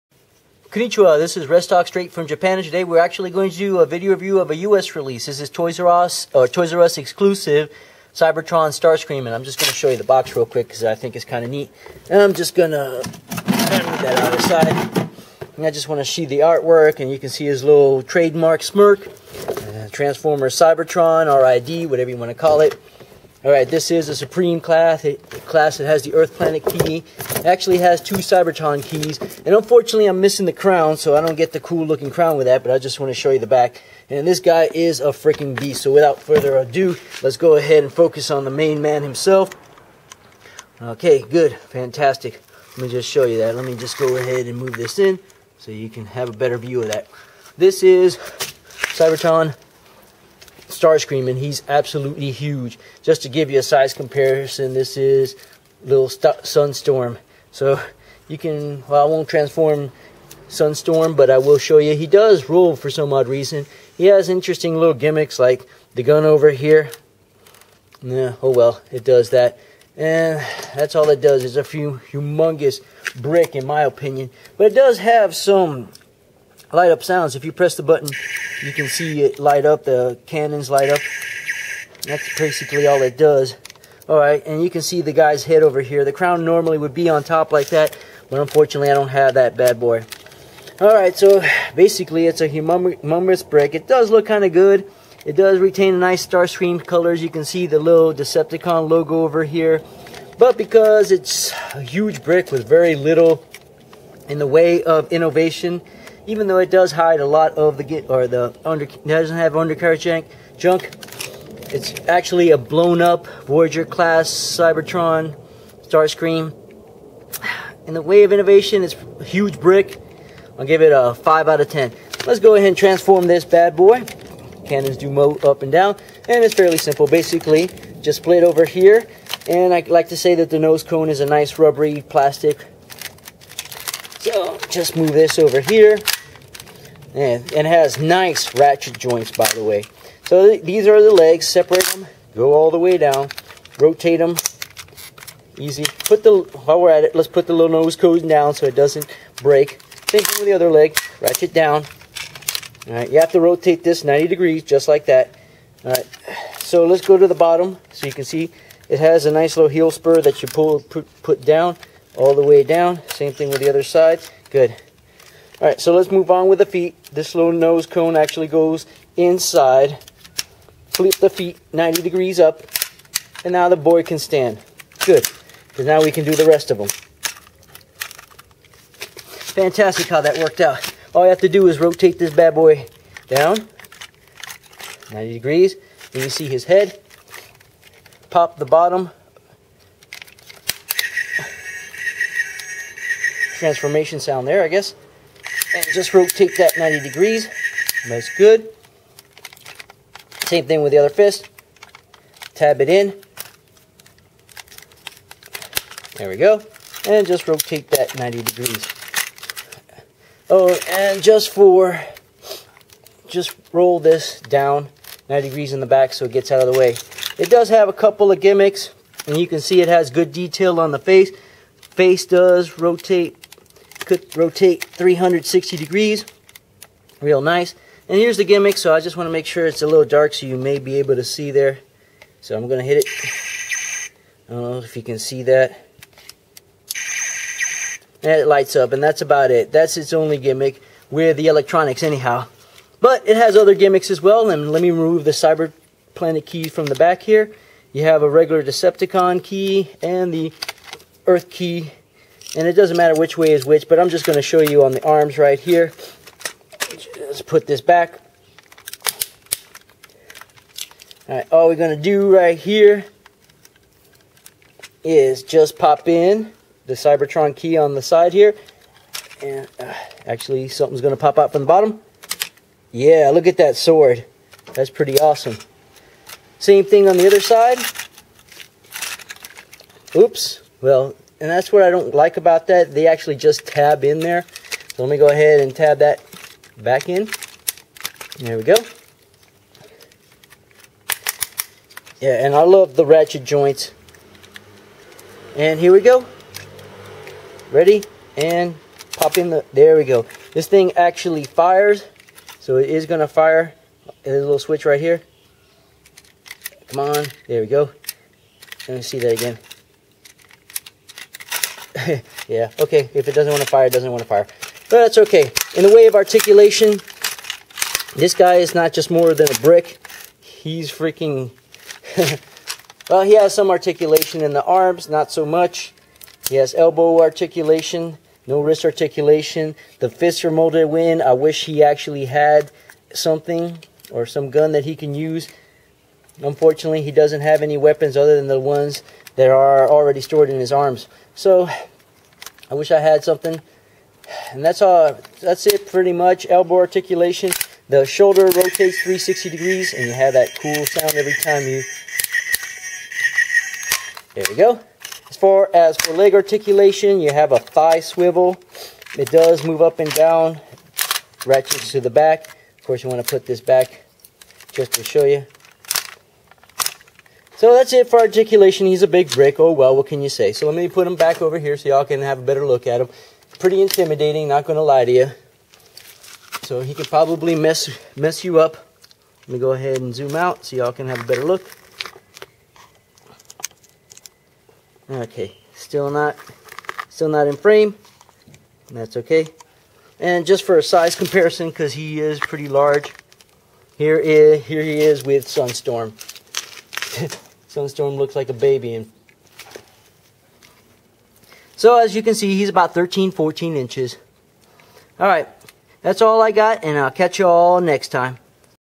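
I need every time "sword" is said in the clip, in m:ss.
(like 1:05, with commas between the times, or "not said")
4:33.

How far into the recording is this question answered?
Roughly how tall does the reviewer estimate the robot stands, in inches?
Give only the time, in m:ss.
6:42.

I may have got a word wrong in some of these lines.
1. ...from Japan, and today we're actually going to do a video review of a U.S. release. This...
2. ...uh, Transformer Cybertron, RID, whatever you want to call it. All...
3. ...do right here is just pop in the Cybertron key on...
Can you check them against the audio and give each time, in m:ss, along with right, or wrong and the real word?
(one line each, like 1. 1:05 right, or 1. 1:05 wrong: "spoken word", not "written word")
1. 0:02 right
2. 0:19 right
3. 4:22 right.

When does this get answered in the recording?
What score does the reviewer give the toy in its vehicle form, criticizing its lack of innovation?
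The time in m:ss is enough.
2:01.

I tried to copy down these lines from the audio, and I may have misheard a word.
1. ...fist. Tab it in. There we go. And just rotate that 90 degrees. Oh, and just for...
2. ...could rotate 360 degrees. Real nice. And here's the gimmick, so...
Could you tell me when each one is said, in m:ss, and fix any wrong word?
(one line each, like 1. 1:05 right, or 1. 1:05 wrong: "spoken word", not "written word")
1. 3:21 right
2. 3:44 right.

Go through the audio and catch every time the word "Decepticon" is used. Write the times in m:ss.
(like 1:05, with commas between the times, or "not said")
1:38, 4:08.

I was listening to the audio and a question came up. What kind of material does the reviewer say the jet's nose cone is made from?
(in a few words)
rubbery plastic.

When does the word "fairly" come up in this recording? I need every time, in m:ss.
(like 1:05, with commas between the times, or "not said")
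2:06.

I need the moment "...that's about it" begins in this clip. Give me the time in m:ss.
3:59.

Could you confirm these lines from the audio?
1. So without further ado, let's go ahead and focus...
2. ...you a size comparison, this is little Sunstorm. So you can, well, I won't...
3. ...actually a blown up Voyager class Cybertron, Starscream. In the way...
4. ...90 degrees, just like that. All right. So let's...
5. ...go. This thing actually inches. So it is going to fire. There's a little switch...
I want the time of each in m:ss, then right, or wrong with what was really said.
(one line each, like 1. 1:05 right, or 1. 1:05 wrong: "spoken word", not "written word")
1. 0:35 right
2. 0:53 right
3. 1:52 right
4. 2:34 right
5. 5:00 wrong: "fires", not "inches".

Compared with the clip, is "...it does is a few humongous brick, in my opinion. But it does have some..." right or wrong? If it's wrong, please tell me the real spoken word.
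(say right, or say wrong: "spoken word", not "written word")
right.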